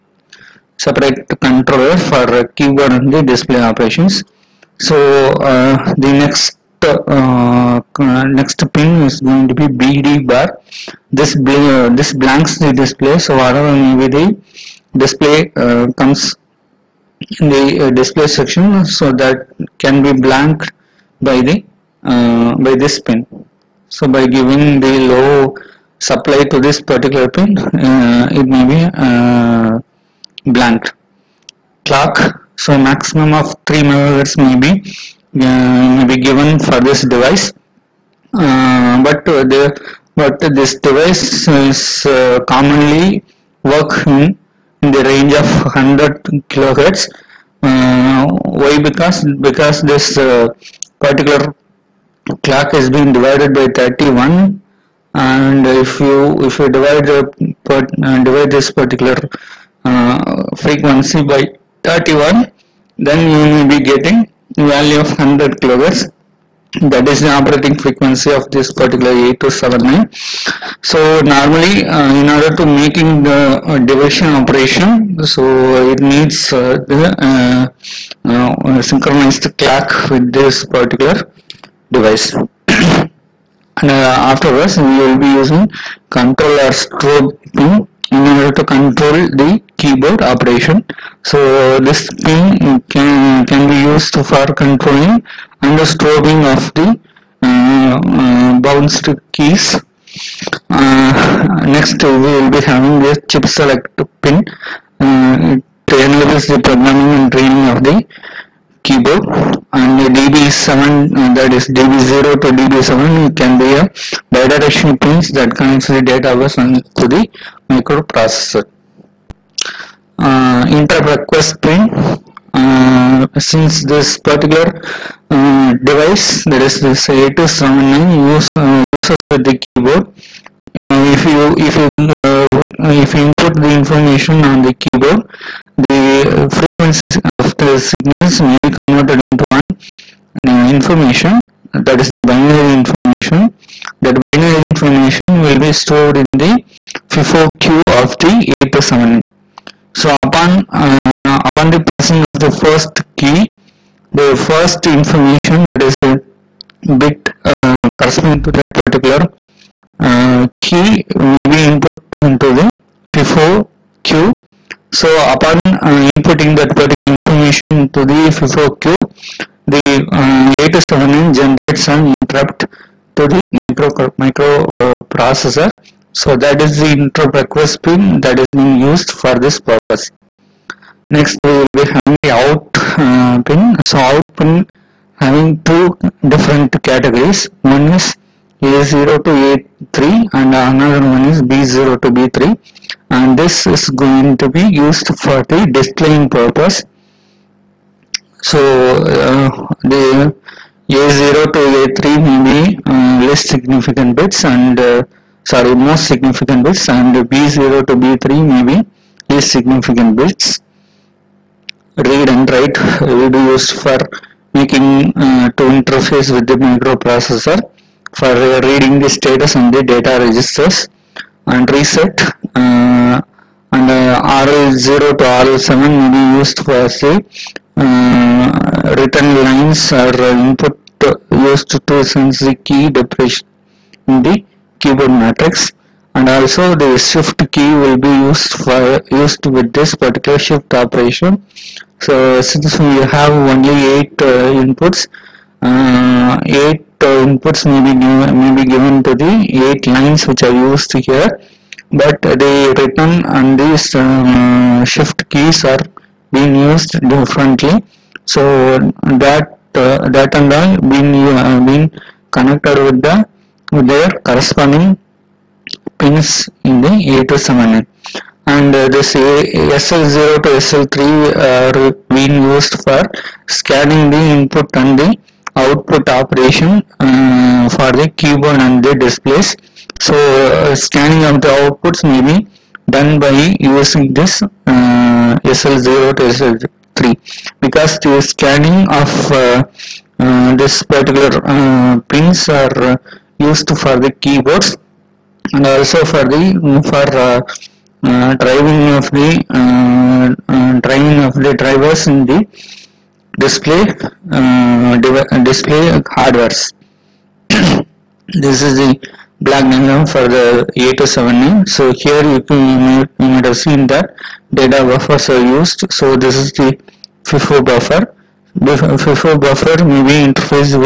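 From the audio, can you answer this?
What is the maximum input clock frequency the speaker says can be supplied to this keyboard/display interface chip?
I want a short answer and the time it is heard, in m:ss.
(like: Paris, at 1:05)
3 megahertz, at 0:33.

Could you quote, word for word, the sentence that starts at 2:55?
Uh, so that is the interrupt request pin that is being used for this purpose.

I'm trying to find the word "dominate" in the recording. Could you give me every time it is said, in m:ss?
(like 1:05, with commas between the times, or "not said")
not said.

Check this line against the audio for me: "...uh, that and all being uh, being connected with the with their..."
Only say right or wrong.
right.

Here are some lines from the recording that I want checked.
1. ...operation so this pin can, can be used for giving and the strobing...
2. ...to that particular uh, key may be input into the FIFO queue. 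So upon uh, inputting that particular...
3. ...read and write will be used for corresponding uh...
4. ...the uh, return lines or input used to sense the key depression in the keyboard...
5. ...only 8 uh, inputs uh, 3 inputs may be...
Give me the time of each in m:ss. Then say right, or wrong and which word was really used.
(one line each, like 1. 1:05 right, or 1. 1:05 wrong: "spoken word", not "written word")
1. 1:30 wrong: "controlling", not "giving"
2. 2:38 right
3. 3:31 wrong: "making", not "corresponding"
4. 3:46 right
5. 4:03 wrong: "8", not "3".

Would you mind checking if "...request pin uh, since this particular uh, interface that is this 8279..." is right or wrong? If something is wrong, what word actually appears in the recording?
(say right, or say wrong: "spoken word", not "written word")
wrong: "device", not "interface".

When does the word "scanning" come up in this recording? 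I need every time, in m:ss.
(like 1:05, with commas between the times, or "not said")
4:33, 4:40, 4:48.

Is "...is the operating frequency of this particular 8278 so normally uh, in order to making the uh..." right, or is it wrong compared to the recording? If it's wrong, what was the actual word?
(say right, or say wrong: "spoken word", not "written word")
wrong: "8279", not "8278".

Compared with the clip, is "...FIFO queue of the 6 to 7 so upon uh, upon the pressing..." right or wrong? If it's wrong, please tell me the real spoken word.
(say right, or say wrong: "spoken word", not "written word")
wrong: "8", not "6".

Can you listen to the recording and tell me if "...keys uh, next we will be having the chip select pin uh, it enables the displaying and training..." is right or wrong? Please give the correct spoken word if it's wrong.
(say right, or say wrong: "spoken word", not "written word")
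wrong: "programming", not "displaying".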